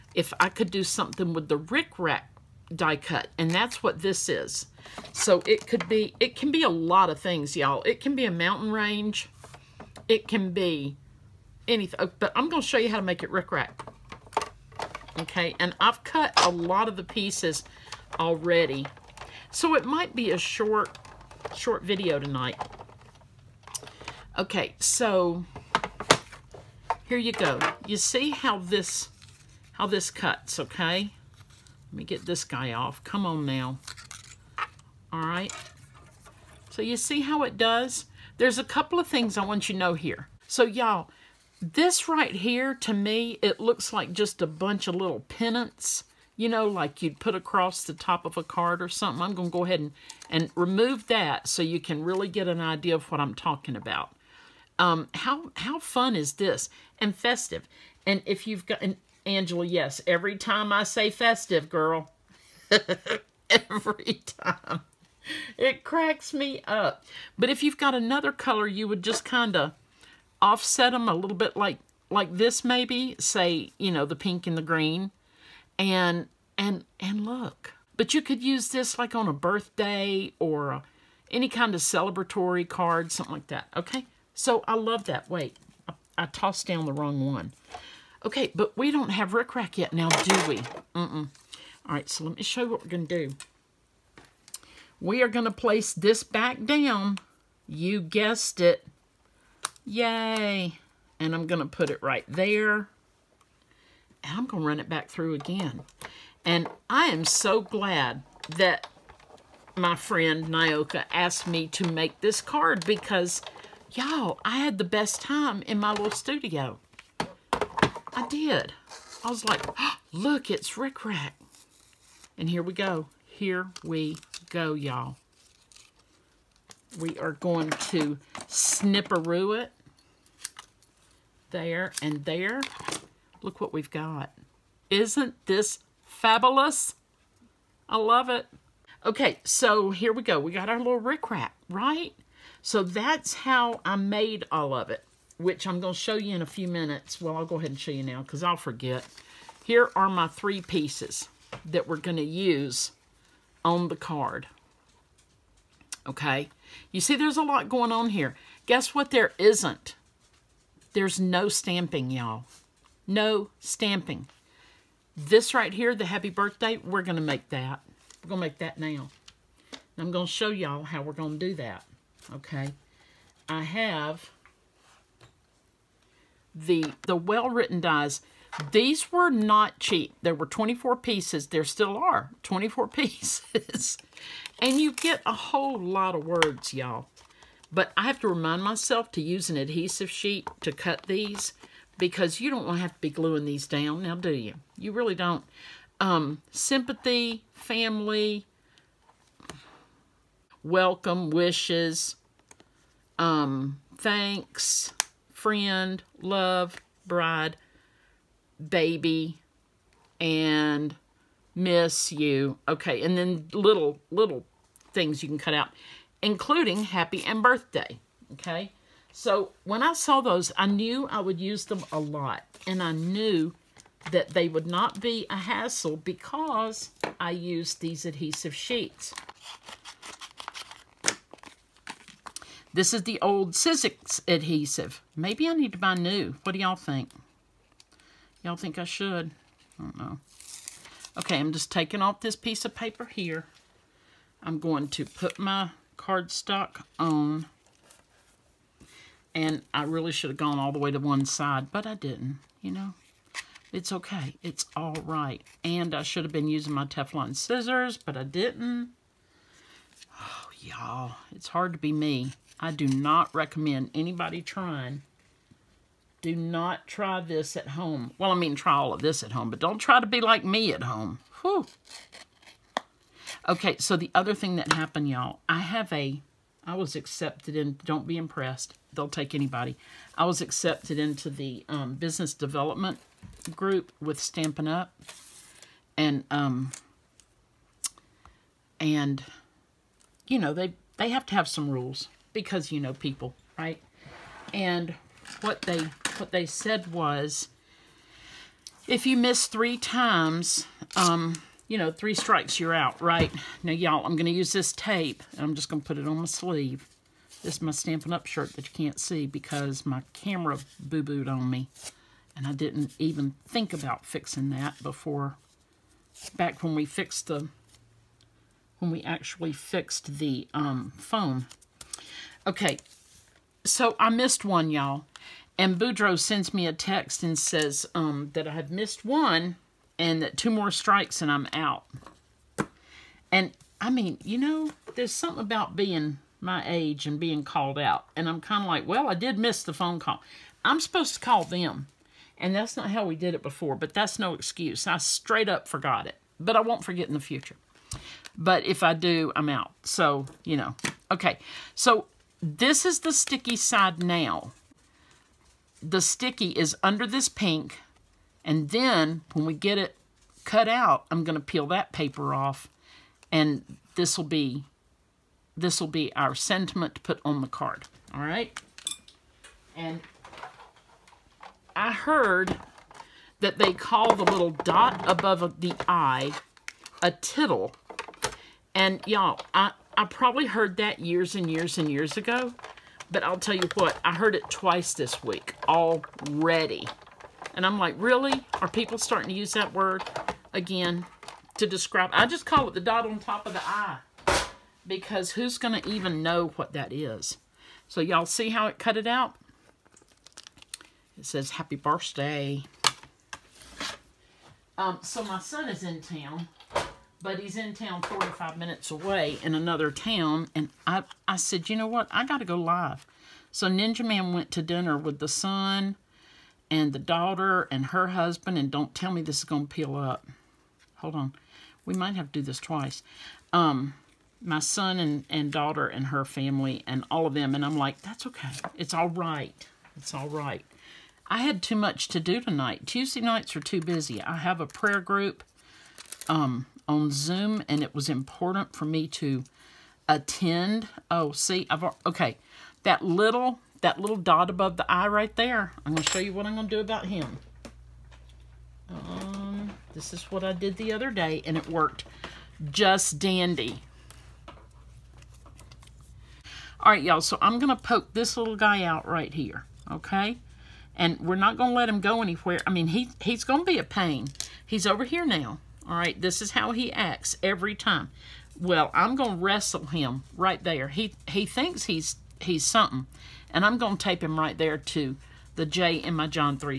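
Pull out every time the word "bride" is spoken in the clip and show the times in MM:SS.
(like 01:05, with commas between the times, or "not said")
03:27.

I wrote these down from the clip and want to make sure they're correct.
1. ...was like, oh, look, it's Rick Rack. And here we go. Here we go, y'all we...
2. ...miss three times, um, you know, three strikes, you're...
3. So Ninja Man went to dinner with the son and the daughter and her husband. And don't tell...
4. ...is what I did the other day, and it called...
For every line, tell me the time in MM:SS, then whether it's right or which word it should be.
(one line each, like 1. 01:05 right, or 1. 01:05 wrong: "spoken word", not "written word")
1. 01:59 right
2. 04:59 right
3. 06:53 right
4. 07:30 wrong: "worked", not "called".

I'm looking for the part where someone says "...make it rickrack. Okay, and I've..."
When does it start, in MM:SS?
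00:13.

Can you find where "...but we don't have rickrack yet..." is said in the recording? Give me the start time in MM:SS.
01:28.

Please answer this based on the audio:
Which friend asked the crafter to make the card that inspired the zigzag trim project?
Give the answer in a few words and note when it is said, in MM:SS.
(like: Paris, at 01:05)
Nyoka, at 01:50.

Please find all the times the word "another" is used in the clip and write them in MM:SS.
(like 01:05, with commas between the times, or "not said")
01:07, 06:49.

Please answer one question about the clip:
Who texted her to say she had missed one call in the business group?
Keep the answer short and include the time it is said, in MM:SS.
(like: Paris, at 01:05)
Boudreaux, at 05:25.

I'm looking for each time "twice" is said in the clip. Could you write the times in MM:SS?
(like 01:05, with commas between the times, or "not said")
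06:24, 07:02.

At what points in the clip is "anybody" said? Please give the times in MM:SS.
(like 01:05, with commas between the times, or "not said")
04:23, 04:39.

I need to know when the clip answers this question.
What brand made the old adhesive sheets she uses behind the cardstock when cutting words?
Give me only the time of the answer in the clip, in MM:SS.
03:53.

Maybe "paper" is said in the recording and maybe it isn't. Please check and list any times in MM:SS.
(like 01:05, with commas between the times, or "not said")
04:02, 06:01.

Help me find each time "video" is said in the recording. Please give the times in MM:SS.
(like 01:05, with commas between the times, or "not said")
00:21.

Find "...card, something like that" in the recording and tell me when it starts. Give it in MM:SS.
01:22.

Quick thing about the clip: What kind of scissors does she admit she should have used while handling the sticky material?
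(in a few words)
Teflon scissors.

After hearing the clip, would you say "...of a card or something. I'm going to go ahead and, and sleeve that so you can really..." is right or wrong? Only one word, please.
wrong.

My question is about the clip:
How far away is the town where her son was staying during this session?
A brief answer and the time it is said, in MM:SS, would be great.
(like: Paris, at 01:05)
45 minutes, at 06:48.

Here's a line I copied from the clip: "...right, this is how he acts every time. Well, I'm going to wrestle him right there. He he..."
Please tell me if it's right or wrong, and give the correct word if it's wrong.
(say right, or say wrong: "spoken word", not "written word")
right.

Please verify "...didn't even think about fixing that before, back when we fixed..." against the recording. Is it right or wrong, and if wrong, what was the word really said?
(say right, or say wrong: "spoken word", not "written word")
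right.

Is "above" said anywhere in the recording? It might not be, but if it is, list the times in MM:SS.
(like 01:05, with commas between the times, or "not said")
06:15, 07:24.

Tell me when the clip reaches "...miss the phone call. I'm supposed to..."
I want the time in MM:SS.
05:39.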